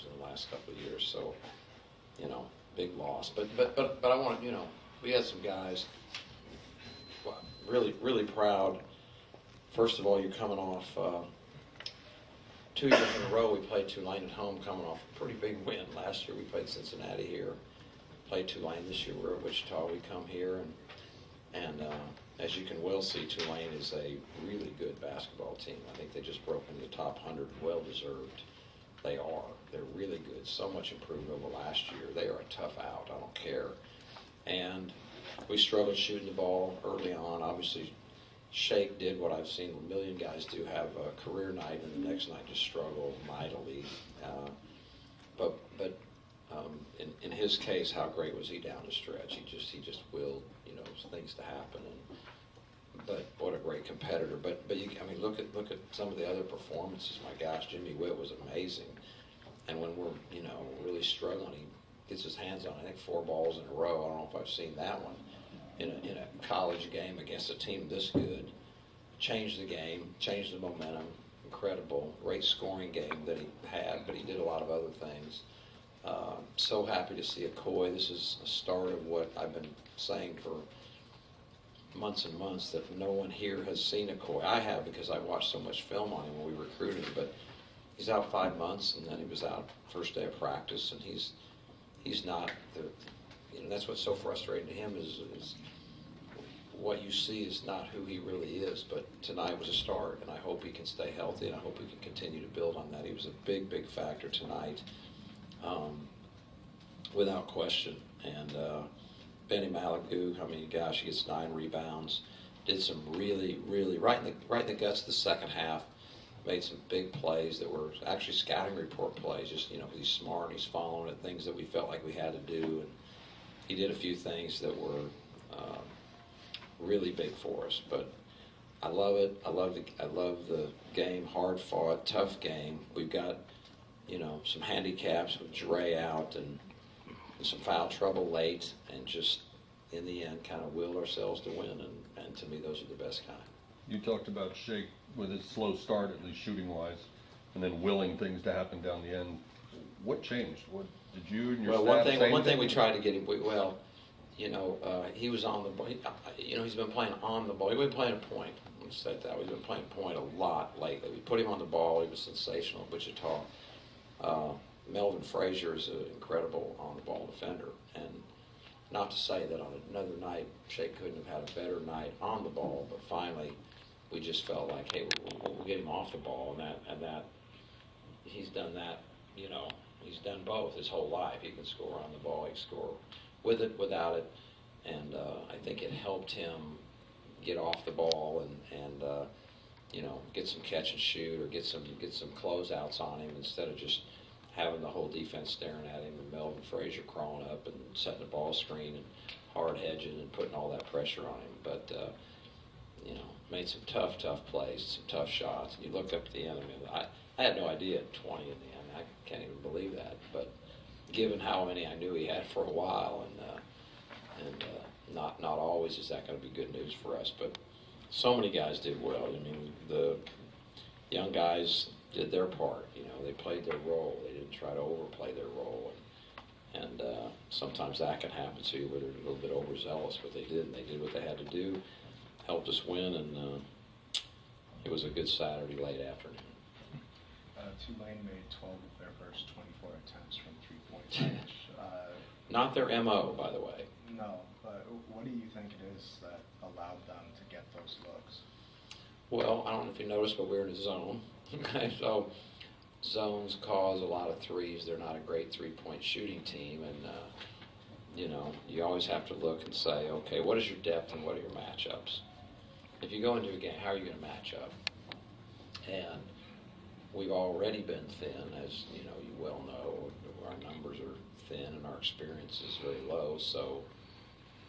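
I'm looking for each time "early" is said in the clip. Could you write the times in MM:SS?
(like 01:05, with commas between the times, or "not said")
00:36.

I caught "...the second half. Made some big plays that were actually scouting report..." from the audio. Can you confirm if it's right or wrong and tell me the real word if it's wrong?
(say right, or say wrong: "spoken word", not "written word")
right.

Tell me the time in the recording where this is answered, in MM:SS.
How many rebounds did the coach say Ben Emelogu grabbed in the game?
01:51.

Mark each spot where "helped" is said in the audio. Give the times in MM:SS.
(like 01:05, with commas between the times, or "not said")
03:05, 03:52.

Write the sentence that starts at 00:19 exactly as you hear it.
We come here, and and uh, as you can well see, Tulane is a really good basketball team.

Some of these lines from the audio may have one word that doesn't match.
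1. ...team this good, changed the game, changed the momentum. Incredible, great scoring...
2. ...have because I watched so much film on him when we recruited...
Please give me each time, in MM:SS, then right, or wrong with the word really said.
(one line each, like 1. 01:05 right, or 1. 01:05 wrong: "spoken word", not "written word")
1. 01:07 right
2. 01:24 right.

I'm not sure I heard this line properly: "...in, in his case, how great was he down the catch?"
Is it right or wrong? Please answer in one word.
wrong.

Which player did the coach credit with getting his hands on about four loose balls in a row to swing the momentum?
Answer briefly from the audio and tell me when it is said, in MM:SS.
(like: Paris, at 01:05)
Jimmy Whitt, at 00:57.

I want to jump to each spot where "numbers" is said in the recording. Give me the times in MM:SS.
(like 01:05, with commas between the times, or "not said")
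04:30.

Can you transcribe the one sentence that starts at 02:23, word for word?
You talked about Shake with his slow start, at least shooting wise, and then willing things to happen down the end.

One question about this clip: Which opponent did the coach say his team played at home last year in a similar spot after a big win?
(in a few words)
Cincinnati.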